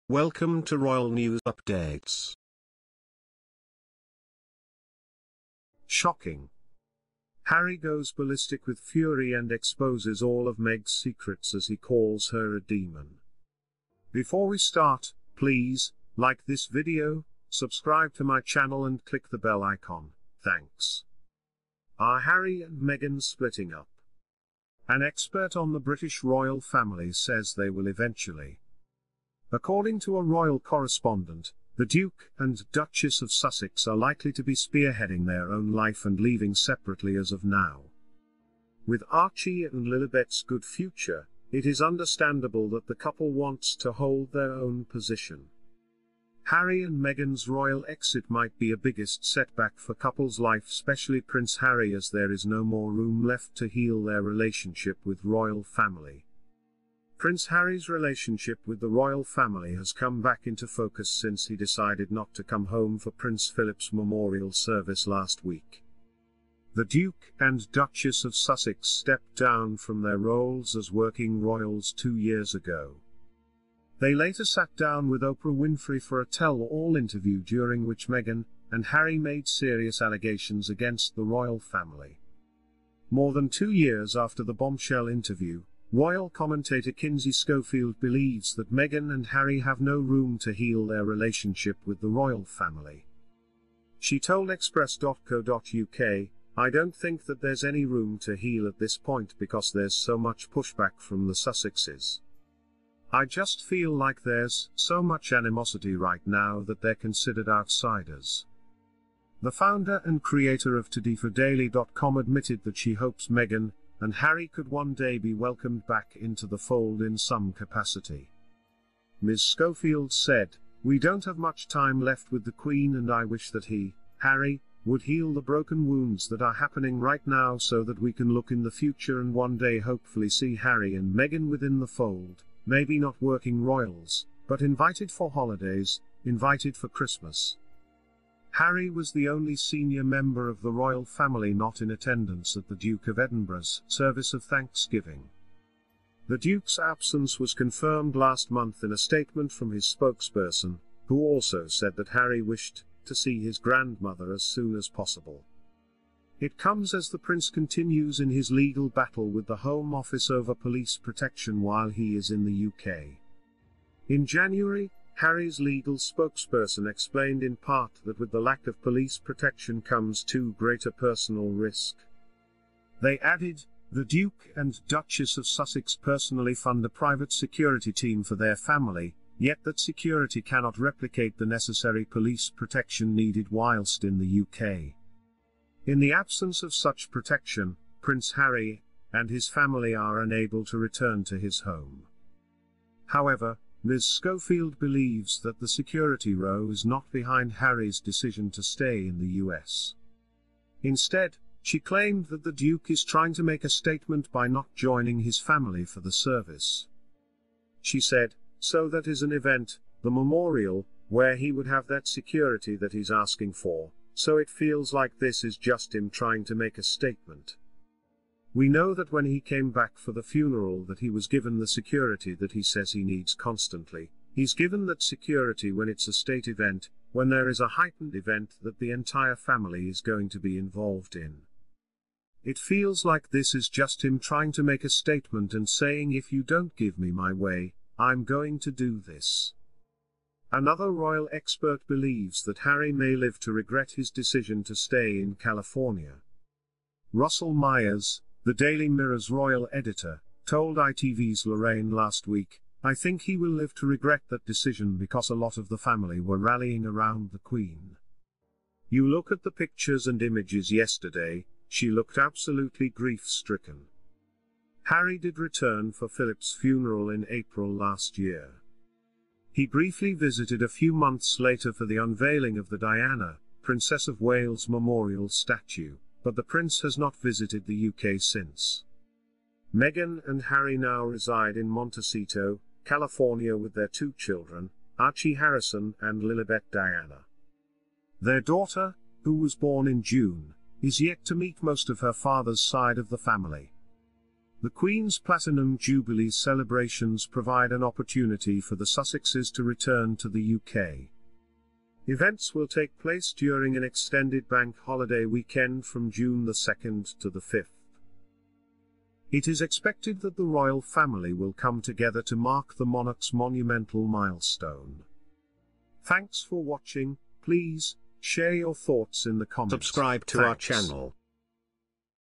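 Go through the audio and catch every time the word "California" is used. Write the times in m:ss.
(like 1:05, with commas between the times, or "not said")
4:05, 4:42.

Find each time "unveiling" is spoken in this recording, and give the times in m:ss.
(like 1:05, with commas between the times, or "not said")
4:31.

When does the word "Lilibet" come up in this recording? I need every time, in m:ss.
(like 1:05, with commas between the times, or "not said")
0:39, 4:46.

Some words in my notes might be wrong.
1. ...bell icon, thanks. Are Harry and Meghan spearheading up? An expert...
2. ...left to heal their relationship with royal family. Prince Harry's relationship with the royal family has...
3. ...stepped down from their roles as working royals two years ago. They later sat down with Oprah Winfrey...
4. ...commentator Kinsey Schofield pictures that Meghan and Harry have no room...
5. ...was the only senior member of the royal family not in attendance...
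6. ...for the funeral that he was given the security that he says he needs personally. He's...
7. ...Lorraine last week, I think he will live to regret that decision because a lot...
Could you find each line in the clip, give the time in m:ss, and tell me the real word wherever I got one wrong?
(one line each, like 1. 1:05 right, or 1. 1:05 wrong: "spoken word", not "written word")
1. 0:19 wrong: "splitting", not "spearheading"
2. 0:53 right
3. 1:08 right
4. 1:26 wrong: "believes", not "pictures"
5. 2:18 right
6. 3:39 wrong: "constantly", not "personally"
7. 4:11 right.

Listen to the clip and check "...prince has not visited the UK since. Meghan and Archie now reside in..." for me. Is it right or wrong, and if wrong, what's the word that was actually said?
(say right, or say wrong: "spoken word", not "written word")
wrong: "Harry", not "Archie".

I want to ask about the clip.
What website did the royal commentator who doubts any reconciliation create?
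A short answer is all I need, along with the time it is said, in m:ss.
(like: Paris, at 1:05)
ToDiForDaily.com, at 1:50.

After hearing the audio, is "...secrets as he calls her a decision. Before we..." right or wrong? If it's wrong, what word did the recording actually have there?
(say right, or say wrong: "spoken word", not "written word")
wrong: "demon", not "decision".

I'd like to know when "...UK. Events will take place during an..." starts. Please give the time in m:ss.
5:00.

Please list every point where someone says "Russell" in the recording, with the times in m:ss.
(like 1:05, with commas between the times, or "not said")
4:07.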